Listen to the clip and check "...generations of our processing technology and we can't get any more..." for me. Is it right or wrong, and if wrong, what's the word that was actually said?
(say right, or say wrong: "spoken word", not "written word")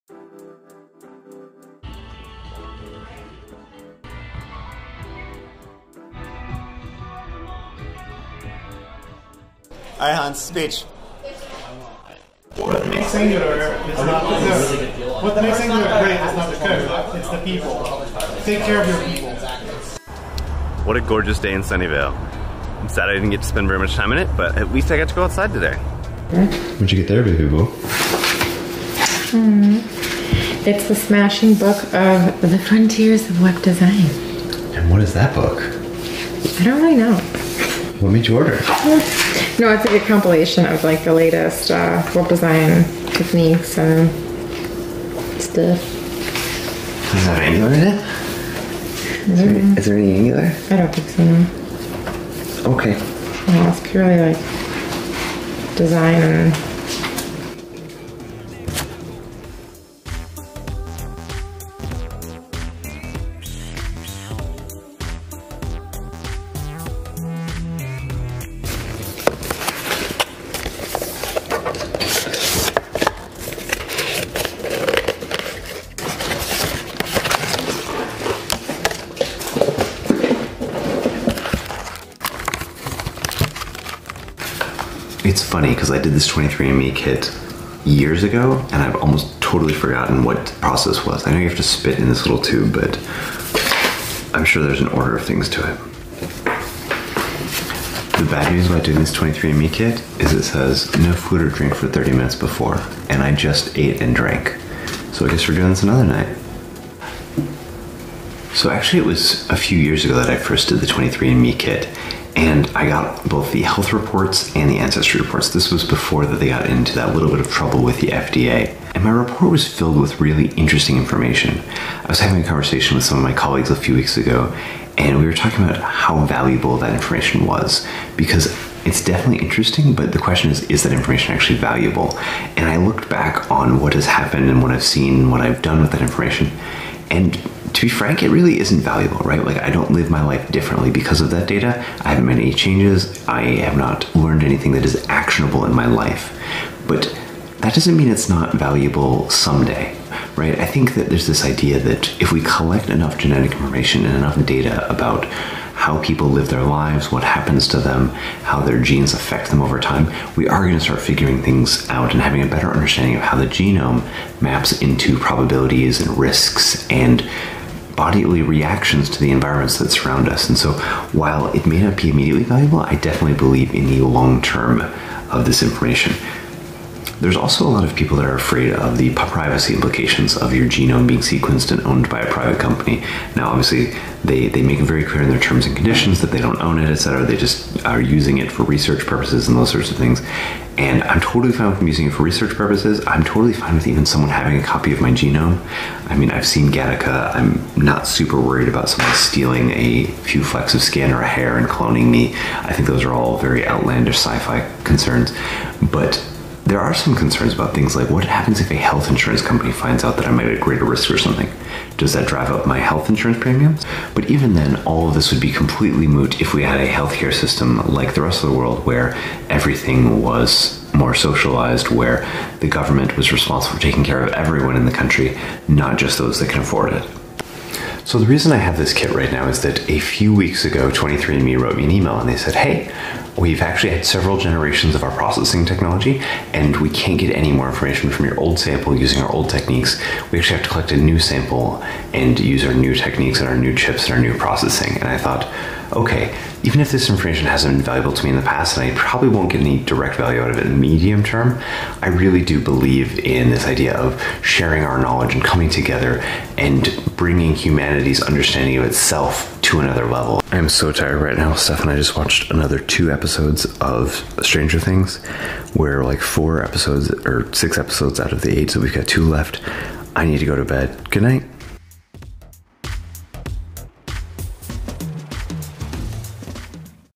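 right.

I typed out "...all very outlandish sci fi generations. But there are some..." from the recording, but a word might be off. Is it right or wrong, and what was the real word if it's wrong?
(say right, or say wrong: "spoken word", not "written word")
wrong: "concerns", not "generations".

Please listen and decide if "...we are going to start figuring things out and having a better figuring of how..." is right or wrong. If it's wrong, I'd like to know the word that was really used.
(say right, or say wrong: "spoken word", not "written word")
wrong: "understanding", not "figuring".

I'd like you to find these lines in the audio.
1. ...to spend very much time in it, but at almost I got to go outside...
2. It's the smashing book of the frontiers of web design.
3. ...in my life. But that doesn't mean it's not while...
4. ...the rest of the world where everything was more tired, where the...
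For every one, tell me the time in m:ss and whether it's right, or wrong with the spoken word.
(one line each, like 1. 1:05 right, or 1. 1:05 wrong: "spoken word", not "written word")
1. 0:23 wrong: "least", not "almost"
2. 0:30 right
3. 2:25 wrong: "valuable", not "while"
4. 3:38 wrong: "socialized", not "tired".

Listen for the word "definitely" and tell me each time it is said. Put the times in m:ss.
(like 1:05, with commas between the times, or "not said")
2:09, 2:52.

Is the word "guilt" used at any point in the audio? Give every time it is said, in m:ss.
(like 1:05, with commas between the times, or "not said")
not said.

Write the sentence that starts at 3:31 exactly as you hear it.
Does that drive up my health insurance premiums?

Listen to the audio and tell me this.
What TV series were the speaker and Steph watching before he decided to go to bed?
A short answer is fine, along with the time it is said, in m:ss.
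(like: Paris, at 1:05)
Stranger Things, at 4:24.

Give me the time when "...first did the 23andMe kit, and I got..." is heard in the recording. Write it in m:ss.
1:50.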